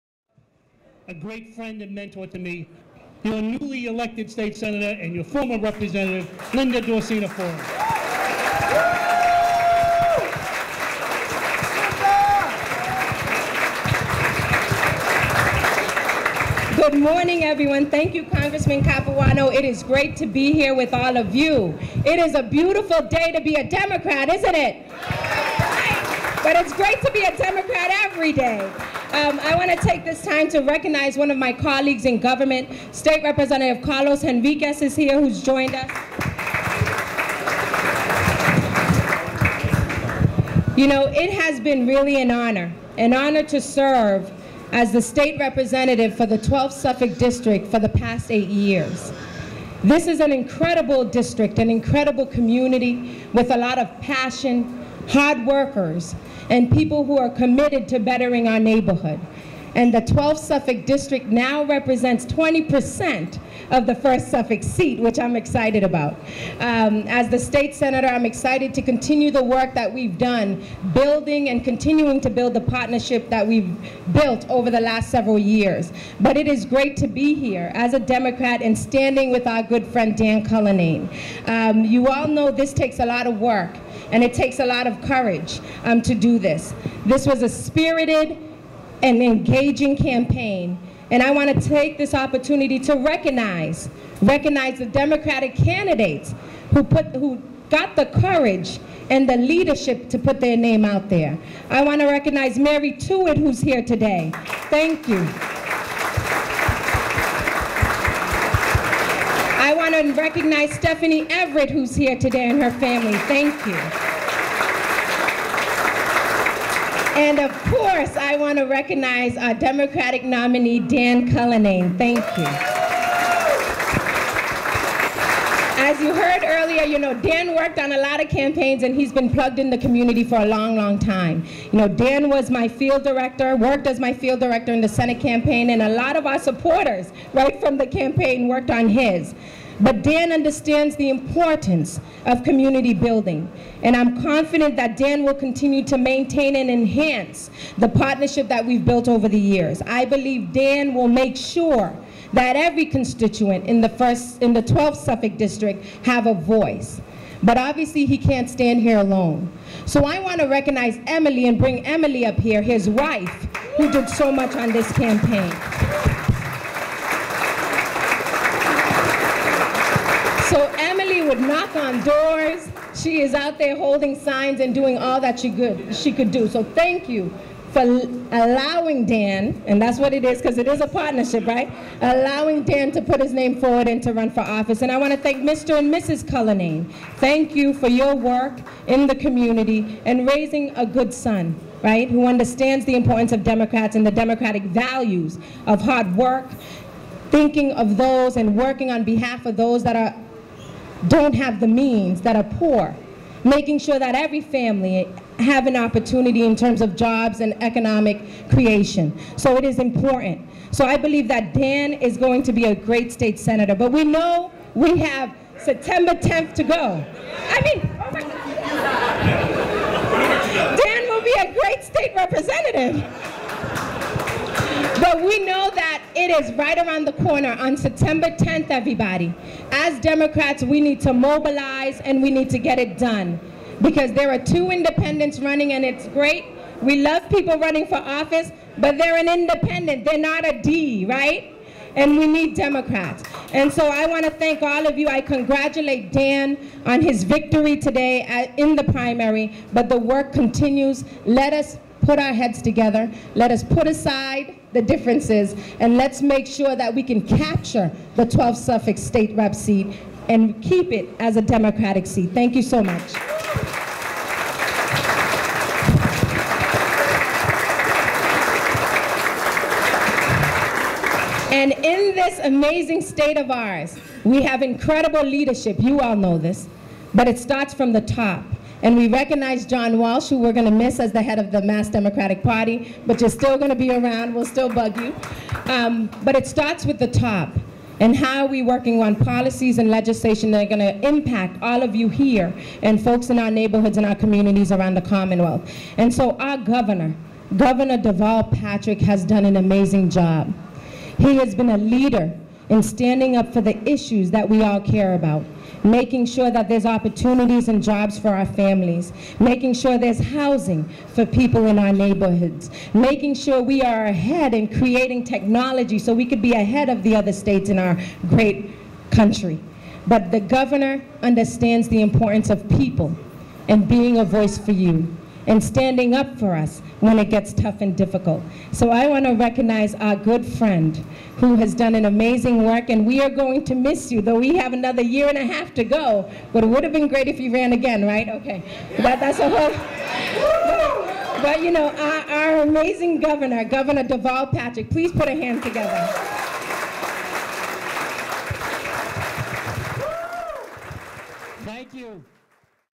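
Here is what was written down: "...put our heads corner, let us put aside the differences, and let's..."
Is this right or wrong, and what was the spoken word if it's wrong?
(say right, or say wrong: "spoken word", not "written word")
wrong: "together", not "corner".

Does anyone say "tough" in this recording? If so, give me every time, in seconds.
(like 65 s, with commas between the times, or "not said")
327 s.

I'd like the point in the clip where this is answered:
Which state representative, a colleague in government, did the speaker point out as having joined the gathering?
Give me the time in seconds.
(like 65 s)
33 s.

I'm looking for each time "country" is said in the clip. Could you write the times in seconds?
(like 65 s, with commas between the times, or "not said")
319 s.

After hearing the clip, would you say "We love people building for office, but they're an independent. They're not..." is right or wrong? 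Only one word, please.
wrong.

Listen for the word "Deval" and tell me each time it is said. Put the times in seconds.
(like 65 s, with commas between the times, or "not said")
297 s, 344 s.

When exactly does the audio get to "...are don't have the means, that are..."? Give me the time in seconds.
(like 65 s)
199 s.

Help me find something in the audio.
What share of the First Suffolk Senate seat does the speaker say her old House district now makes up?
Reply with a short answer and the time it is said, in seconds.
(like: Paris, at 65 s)
20%, at 62 s.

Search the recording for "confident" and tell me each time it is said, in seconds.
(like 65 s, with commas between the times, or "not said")
144 s.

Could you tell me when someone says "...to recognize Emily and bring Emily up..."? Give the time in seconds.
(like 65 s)
160 s.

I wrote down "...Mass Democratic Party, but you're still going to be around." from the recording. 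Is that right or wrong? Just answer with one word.
right.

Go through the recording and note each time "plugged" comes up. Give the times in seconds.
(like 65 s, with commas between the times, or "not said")
129 s.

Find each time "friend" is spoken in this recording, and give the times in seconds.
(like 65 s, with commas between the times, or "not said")
1 s, 79 s, 330 s.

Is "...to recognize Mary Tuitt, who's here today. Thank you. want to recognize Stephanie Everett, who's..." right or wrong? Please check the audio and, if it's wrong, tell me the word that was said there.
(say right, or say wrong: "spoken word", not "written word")
right.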